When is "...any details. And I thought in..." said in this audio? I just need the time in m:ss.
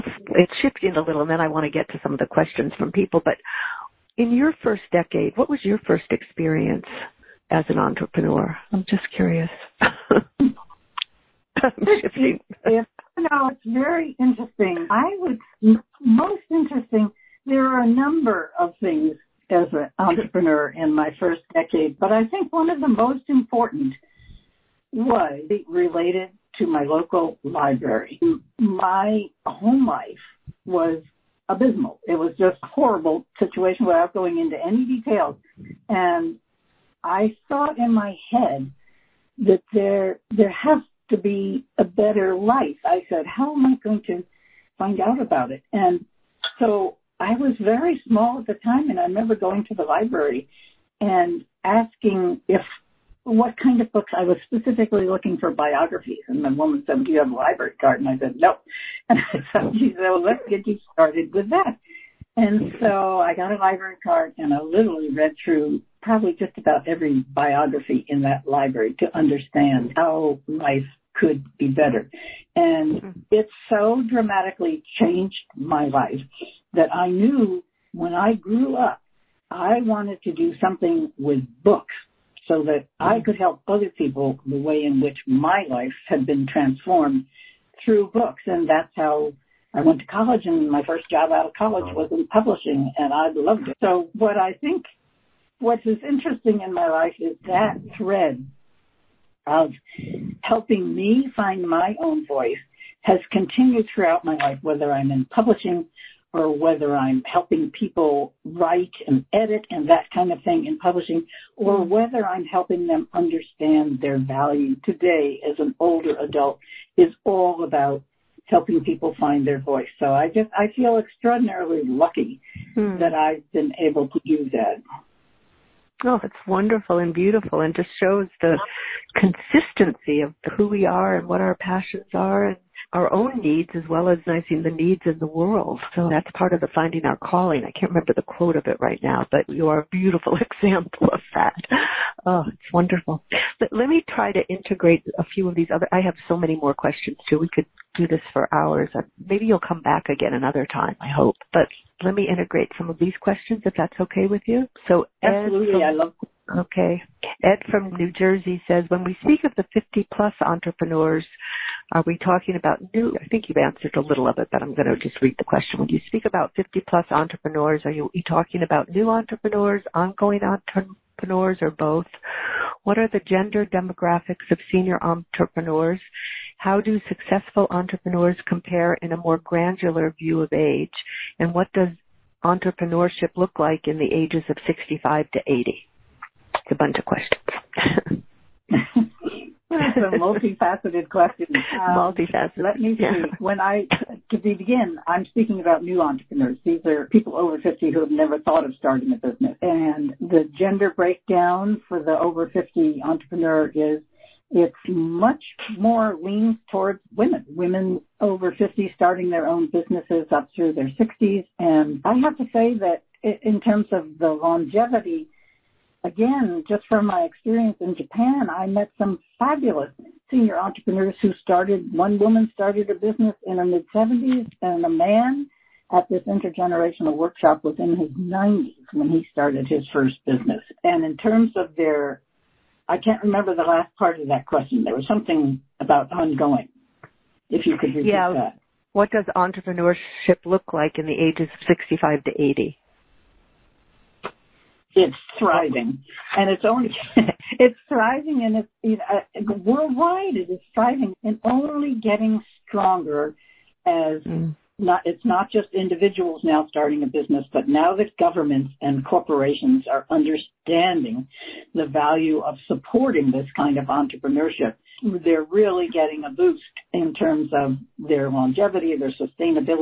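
0:34.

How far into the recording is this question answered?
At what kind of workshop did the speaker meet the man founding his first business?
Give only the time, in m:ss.
3:46.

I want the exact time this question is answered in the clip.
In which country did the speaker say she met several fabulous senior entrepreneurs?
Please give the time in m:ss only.
3:37.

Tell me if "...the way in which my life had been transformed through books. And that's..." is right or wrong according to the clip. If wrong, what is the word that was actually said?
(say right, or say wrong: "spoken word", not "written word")
right.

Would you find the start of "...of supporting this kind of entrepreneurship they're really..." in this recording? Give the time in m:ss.
4:22.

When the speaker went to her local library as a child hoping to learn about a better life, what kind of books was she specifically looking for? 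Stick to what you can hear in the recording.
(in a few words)
Biographies.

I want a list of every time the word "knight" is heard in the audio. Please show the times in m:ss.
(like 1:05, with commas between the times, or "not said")
not said.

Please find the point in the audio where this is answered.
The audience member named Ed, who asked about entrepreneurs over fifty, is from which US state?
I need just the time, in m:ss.
2:37.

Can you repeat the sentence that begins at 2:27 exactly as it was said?
We could do this for hours.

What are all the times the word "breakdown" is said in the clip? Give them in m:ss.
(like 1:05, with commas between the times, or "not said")
3:20.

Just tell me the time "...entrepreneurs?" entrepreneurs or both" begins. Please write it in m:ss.
2:50.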